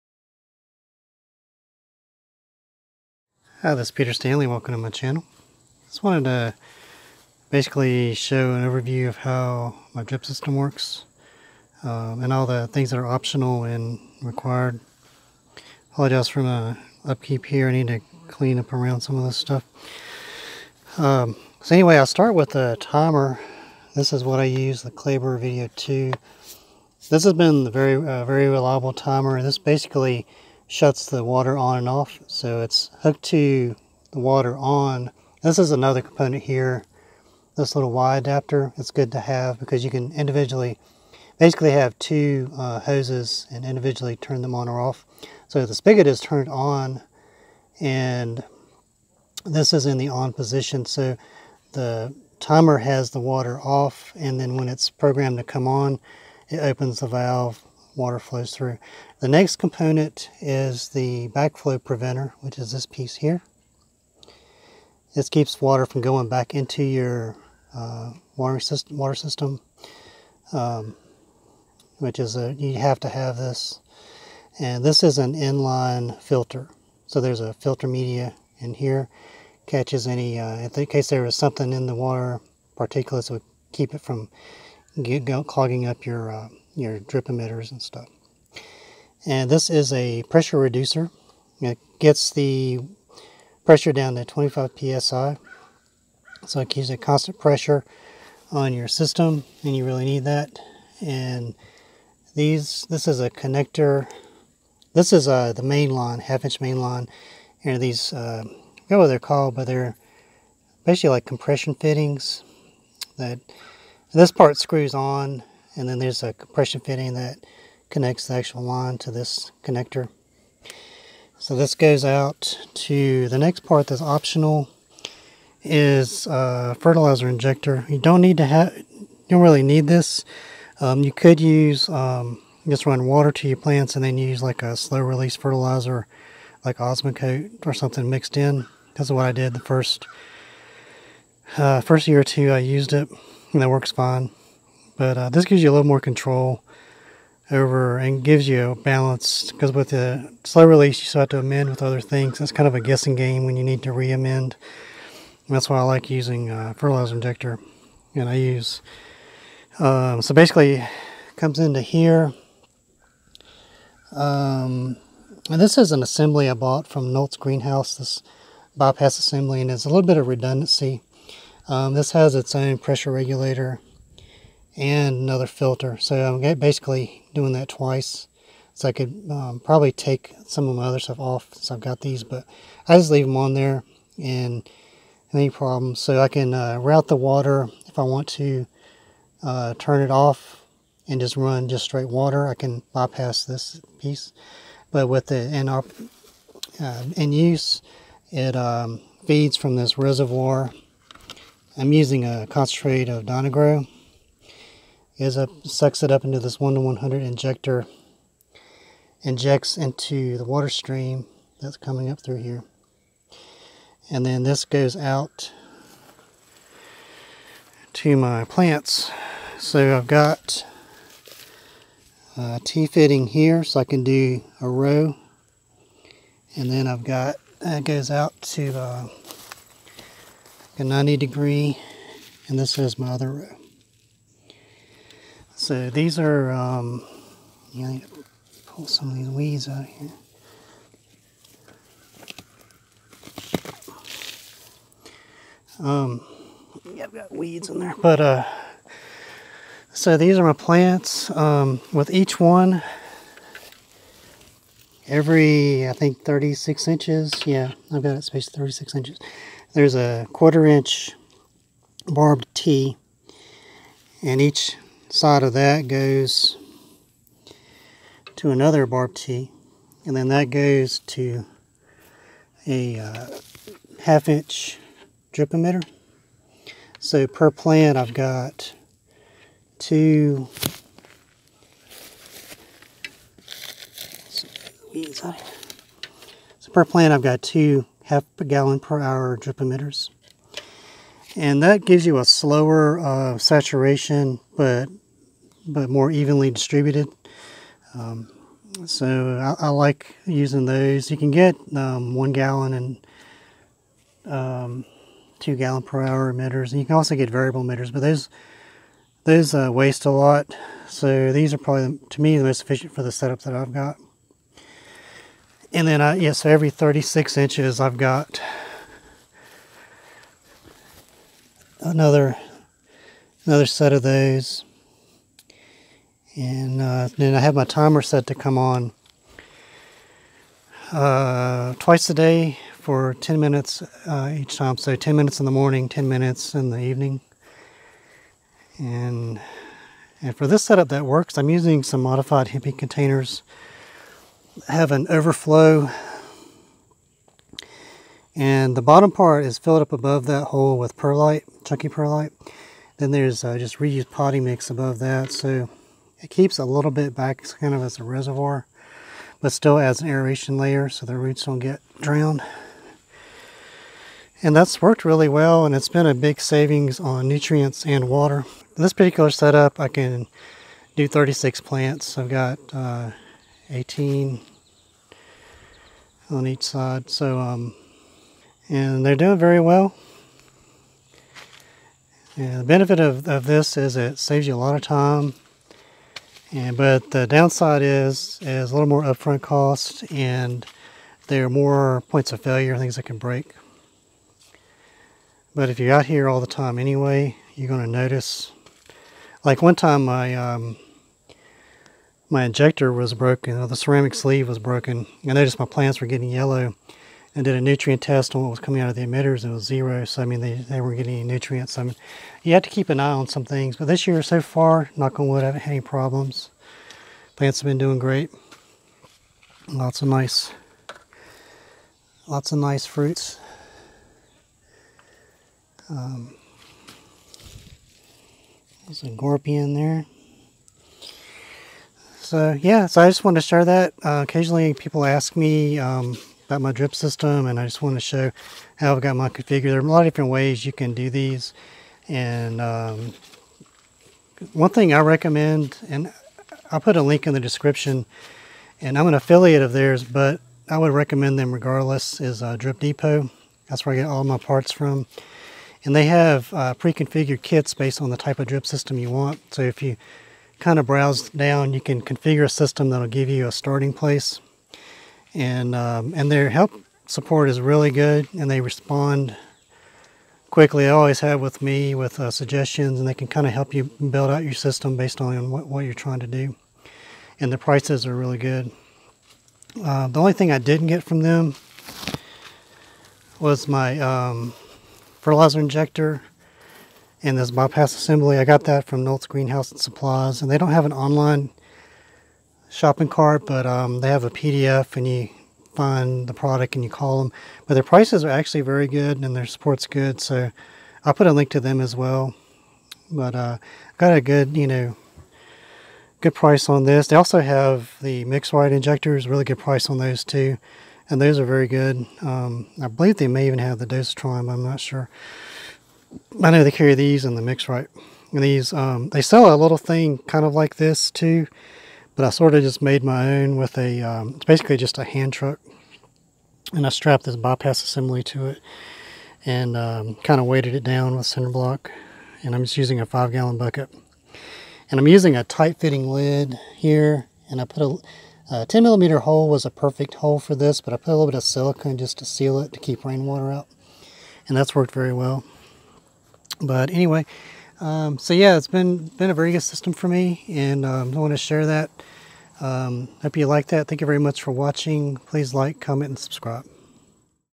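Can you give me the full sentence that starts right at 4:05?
Um, yeah, I've got weeds in there, but uh, so these are my plants.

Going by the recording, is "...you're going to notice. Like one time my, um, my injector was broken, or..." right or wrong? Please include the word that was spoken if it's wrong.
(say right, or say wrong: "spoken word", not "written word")
right.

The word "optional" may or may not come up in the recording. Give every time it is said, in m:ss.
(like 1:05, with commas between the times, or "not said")
0:13, 2:04.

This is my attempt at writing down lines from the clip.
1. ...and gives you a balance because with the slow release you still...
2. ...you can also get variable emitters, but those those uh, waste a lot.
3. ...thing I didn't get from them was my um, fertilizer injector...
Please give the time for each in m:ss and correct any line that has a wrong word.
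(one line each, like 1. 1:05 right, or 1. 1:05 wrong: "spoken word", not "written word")
1. 2:27 right
2. 5:06 right
3. 8:00 right.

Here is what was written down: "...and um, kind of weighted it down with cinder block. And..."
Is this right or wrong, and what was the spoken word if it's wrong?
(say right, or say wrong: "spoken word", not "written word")
right.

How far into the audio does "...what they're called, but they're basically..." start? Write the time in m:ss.
1:48.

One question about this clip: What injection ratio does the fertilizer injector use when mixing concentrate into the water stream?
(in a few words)
1 to 100.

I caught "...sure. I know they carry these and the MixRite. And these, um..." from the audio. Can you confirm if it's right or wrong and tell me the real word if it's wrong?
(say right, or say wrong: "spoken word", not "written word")
right.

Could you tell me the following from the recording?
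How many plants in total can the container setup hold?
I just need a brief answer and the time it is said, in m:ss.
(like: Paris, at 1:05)
36, at 6:11.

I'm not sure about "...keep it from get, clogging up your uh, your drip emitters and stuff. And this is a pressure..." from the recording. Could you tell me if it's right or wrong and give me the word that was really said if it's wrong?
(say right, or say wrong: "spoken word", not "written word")
right.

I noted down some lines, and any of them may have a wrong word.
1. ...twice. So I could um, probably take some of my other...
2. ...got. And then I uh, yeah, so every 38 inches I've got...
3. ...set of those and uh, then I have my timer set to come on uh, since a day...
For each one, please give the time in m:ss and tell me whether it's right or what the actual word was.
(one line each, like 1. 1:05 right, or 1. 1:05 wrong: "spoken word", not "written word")
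1. 2:57 right
2. 5:13 wrong: "36", not "38"
3. 5:23 wrong: "twice", not "since".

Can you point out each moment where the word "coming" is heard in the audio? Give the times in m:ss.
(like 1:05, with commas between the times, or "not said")
3:31, 6:48.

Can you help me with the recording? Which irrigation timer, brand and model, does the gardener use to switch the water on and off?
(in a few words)
Claber Video 2.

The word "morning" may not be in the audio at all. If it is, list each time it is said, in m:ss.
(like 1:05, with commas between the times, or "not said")
5:35.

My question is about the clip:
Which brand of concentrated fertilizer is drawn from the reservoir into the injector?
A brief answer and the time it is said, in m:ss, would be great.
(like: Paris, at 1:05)
Dyna-Gro, at 3:23.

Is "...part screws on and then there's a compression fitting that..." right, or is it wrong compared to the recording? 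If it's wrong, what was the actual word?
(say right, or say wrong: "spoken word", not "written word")
right.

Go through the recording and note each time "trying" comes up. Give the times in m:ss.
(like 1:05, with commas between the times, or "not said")
7:55.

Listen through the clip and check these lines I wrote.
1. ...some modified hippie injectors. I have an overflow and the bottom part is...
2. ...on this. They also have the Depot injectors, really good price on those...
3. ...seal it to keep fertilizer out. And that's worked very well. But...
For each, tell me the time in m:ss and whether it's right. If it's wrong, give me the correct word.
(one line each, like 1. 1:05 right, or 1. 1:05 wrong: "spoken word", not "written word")
1. 5:41 wrong: "containers", not "injectors"
2. 8:26 wrong: "MixRite", not "Depot"
3. 9:02 wrong: "rainwater", not "fertilizer".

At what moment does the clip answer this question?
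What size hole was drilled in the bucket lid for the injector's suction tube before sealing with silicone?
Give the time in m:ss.
8:58.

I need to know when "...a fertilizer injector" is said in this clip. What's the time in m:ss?
2:06.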